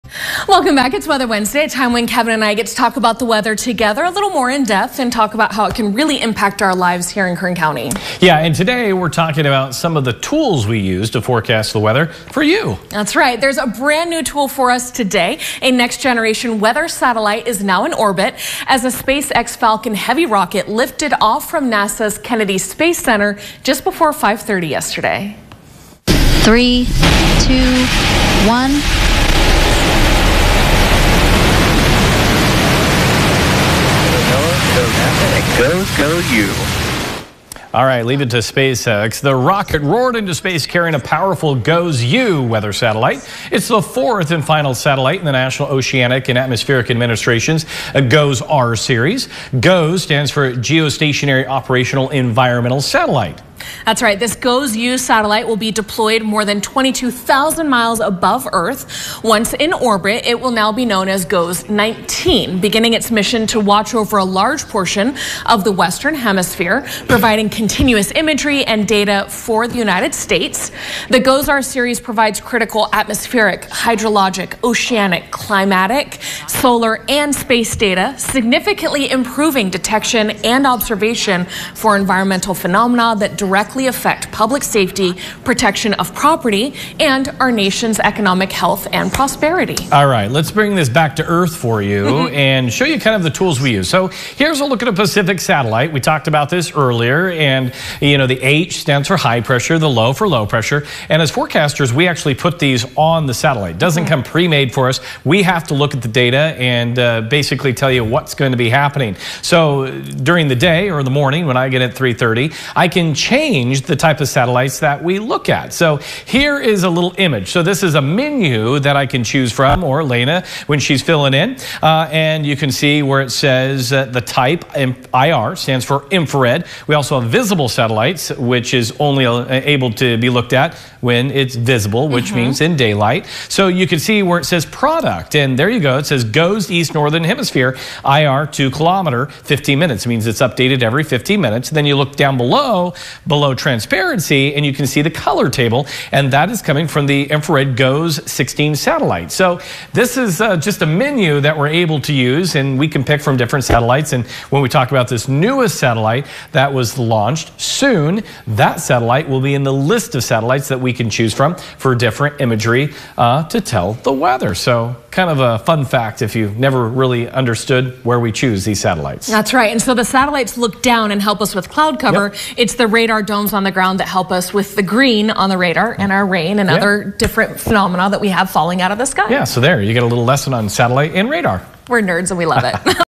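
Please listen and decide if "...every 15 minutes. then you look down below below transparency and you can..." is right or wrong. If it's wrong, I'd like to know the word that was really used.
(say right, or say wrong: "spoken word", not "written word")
right.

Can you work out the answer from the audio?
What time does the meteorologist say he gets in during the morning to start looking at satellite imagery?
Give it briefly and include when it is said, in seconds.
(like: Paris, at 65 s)
3:30, at 111 s.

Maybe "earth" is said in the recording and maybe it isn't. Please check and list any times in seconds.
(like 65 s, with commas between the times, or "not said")
58 s, 91 s.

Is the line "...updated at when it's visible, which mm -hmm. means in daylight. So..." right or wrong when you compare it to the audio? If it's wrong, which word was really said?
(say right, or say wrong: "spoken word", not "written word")
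wrong: "looked", not "updated".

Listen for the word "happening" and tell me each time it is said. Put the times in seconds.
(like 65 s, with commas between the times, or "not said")
108 s.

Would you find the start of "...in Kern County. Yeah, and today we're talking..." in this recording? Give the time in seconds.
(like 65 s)
7 s.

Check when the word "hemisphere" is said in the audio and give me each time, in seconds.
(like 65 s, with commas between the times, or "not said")
66 s, 137 s.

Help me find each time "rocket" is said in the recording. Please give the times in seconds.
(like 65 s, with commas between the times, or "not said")
20 s, 39 s.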